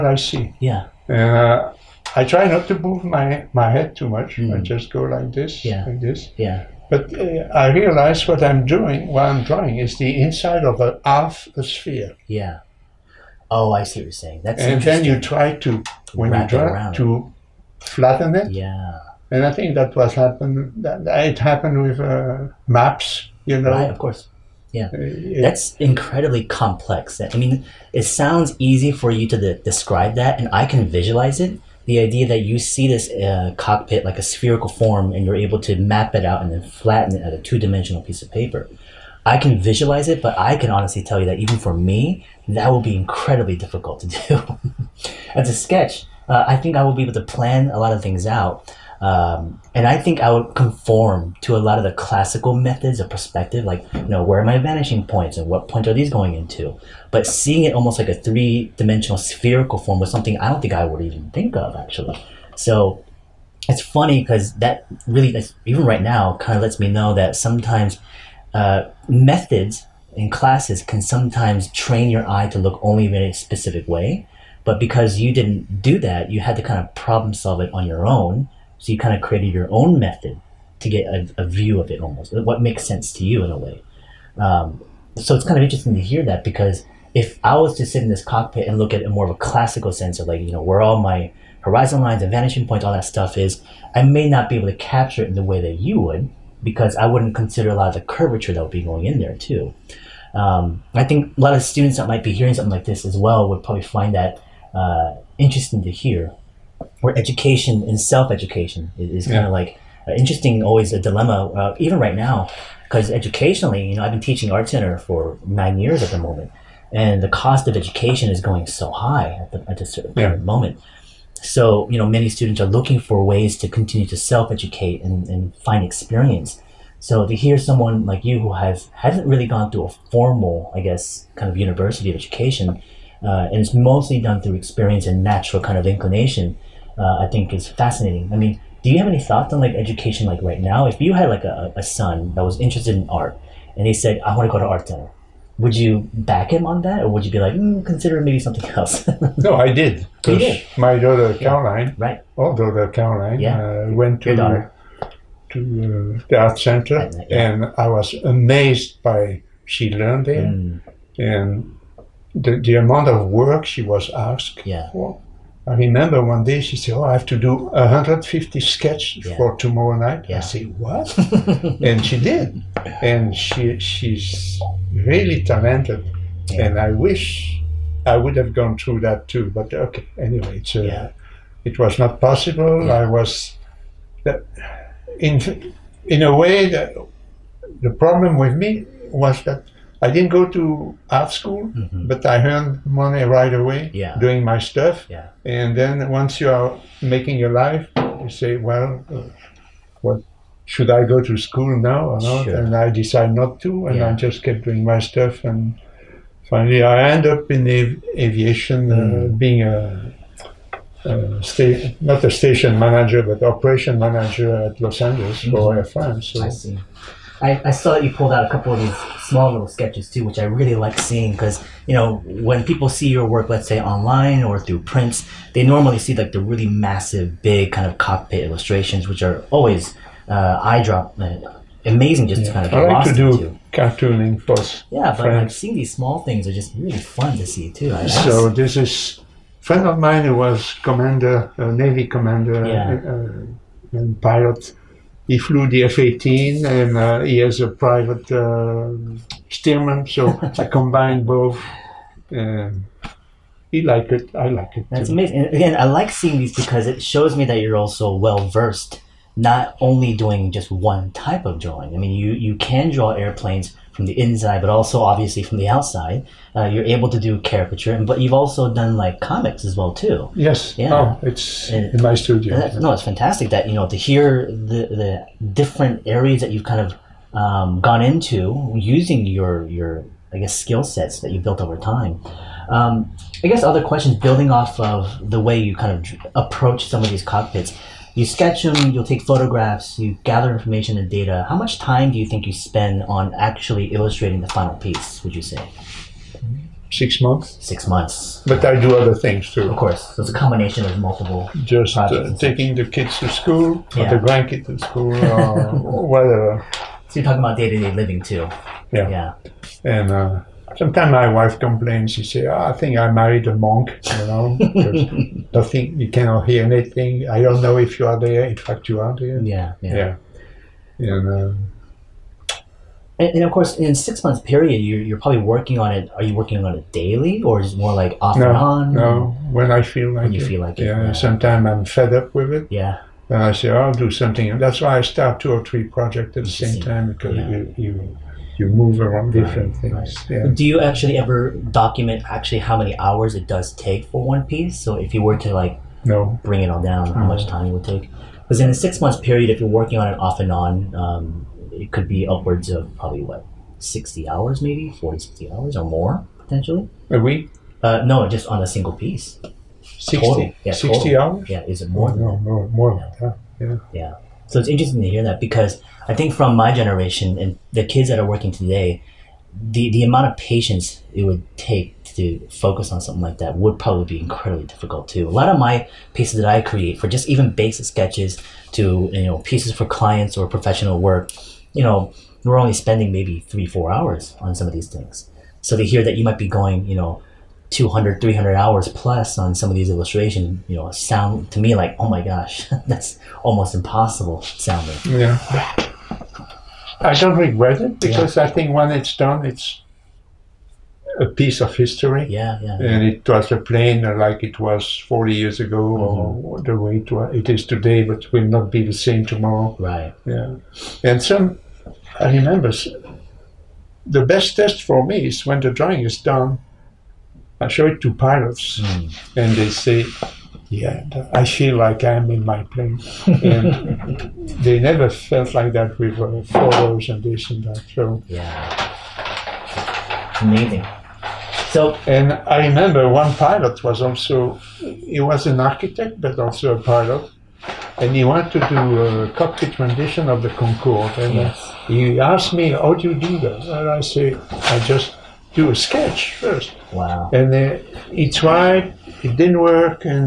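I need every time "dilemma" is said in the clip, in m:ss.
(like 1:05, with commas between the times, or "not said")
1:50.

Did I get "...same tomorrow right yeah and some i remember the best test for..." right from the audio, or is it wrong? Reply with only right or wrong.
right.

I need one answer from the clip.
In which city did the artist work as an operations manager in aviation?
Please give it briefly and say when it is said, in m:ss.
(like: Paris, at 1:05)
Los Angeles, at 3:34.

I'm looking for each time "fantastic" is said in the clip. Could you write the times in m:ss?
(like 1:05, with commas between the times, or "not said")
4:33.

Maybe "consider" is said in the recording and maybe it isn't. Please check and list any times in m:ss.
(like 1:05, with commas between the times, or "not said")
1:37, 2:27.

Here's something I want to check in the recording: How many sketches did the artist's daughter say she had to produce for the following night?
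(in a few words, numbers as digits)
150.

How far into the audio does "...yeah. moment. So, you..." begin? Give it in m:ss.
2:00.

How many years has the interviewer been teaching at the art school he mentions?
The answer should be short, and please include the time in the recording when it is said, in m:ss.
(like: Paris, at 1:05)
9, at 1:55.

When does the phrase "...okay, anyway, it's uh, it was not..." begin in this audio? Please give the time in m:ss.
2:59.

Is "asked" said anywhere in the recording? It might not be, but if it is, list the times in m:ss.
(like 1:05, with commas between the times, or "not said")
2:44, 7:22.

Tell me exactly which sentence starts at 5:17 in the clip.
I don't know if you are there.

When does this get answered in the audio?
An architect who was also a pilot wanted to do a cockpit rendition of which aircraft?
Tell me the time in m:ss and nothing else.
7:20.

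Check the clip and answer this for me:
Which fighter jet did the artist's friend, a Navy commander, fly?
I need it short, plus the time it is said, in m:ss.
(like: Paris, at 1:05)
F-18, at 4:05.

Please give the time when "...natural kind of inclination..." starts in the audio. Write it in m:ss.
2:15.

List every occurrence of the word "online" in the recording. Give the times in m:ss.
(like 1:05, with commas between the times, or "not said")
3:43.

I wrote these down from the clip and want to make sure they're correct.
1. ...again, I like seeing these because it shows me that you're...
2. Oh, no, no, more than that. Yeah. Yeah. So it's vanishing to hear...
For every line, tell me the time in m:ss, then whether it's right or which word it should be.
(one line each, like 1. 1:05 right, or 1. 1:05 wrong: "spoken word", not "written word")
1. 4:15 right
2. 6:02 wrong: "interesting", not "vanishing".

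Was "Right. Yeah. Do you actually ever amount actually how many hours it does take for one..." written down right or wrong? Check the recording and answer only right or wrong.
wrong.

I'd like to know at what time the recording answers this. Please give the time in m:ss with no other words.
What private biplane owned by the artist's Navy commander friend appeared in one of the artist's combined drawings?
4:09.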